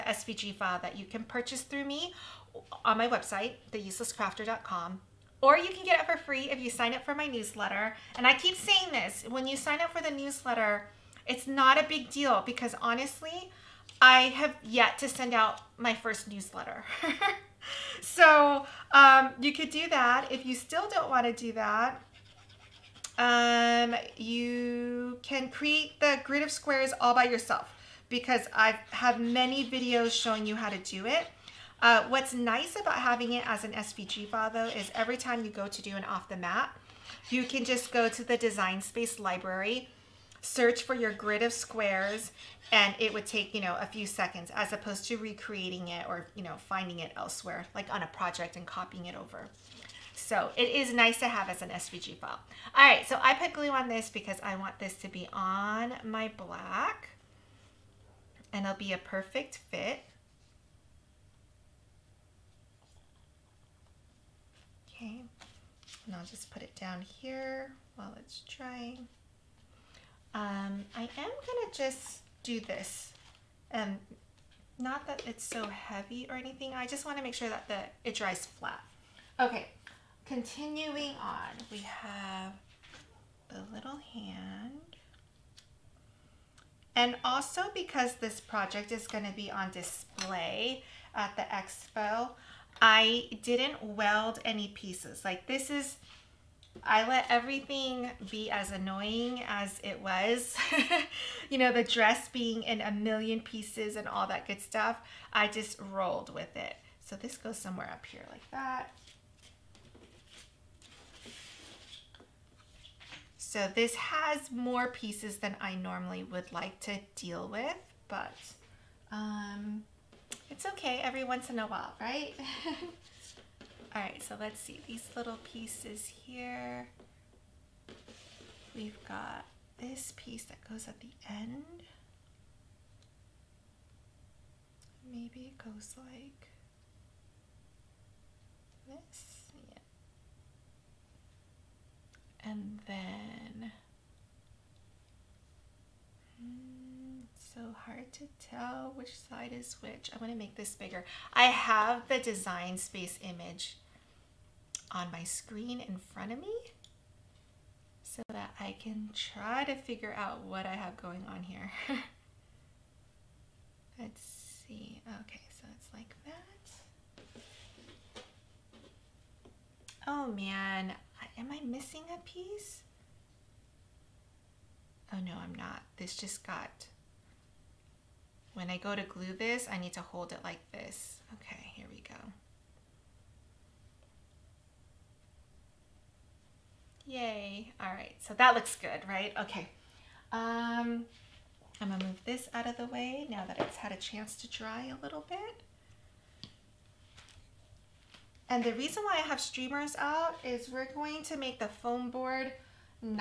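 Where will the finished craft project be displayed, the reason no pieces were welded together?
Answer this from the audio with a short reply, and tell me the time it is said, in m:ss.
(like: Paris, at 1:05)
the expo, at 1:31.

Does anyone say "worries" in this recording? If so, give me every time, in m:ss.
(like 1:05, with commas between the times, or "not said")
not said.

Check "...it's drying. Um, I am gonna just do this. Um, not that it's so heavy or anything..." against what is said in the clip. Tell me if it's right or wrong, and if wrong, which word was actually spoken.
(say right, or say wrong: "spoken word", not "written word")
right.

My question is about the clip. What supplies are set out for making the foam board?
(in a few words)
streamers.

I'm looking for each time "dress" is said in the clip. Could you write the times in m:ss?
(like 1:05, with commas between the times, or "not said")
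1:41.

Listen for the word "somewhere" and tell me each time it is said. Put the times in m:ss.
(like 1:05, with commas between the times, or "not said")
1:47.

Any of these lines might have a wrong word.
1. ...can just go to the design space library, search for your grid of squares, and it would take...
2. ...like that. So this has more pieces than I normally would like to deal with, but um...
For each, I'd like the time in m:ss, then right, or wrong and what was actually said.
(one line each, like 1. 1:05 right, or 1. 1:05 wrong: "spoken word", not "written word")
1. 0:37 right
2. 1:48 right.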